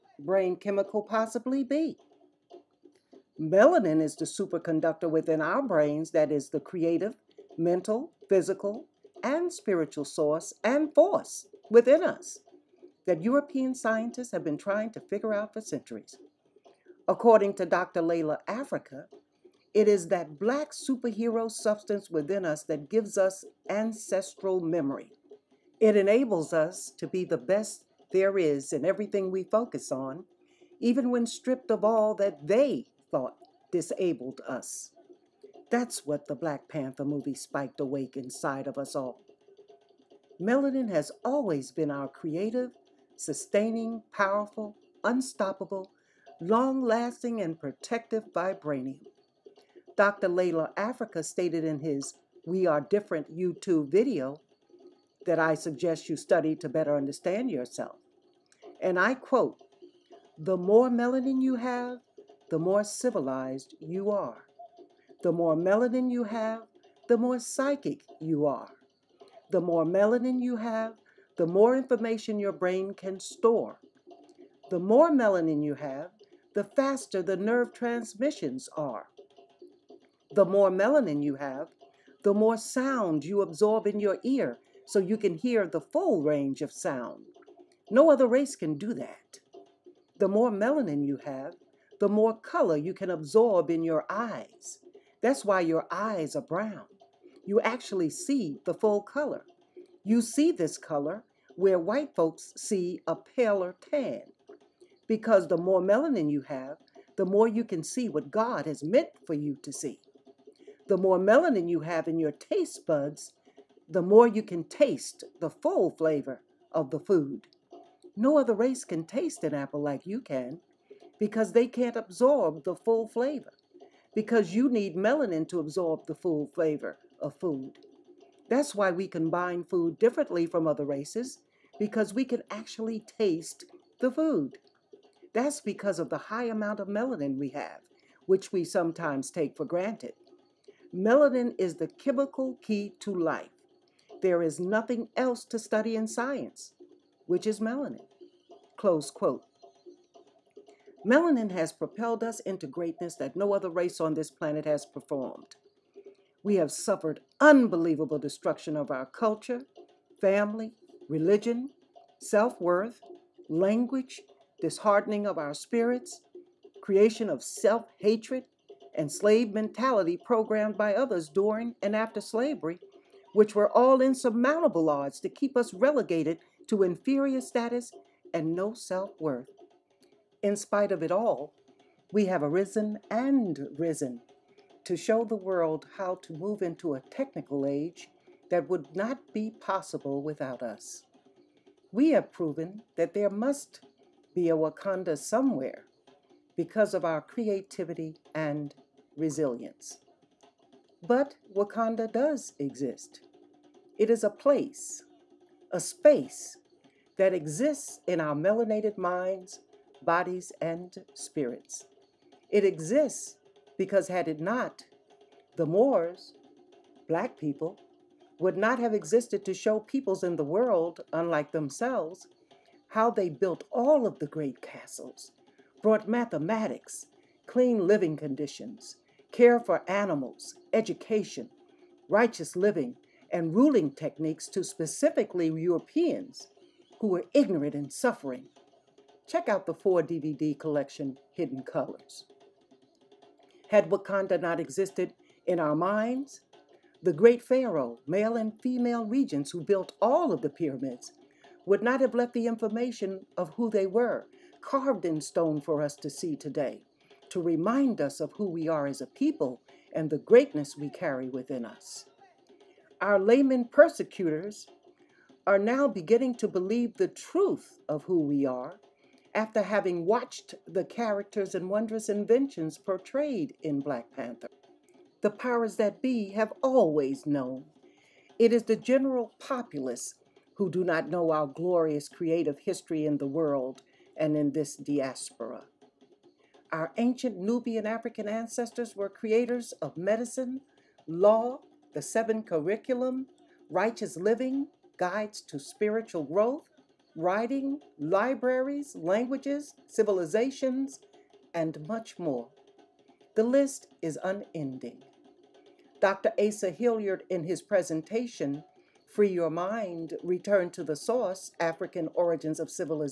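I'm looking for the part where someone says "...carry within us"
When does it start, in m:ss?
4:20.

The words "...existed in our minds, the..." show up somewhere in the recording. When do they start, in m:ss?
4:04.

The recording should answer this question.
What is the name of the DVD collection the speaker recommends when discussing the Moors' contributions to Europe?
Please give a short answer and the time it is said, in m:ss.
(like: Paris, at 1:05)
Hidden Colors, at 4:01.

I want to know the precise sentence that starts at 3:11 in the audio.
We have proven that there must be a Wakanda somewhere because of our creativity and resilience.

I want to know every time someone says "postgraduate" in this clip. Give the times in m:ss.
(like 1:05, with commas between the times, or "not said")
not said.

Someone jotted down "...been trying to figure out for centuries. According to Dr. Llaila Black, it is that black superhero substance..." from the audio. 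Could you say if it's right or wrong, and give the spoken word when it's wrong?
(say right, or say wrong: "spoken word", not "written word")
wrong: "Afrika", not "Black".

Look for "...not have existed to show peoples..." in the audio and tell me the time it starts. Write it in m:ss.
3:38.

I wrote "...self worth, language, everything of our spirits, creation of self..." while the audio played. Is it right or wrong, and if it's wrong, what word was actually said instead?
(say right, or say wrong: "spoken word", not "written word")
wrong: "disheartening", not "everything".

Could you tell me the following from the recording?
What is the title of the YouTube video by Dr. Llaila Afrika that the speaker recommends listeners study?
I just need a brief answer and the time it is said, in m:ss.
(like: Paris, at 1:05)
We Are Different, at 0:52.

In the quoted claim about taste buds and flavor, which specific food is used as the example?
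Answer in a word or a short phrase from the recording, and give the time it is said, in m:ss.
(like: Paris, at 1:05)
An apple, at 1:59.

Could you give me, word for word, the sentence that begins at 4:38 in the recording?
It is the general populace who do not know our glorious creative history in the world and in this diaspora.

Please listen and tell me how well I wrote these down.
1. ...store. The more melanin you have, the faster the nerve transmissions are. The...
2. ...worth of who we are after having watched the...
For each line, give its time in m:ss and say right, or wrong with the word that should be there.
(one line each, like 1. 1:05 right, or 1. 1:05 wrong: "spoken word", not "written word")
1. 1:13 right
2. 4:27 wrong: "truth", not "worth".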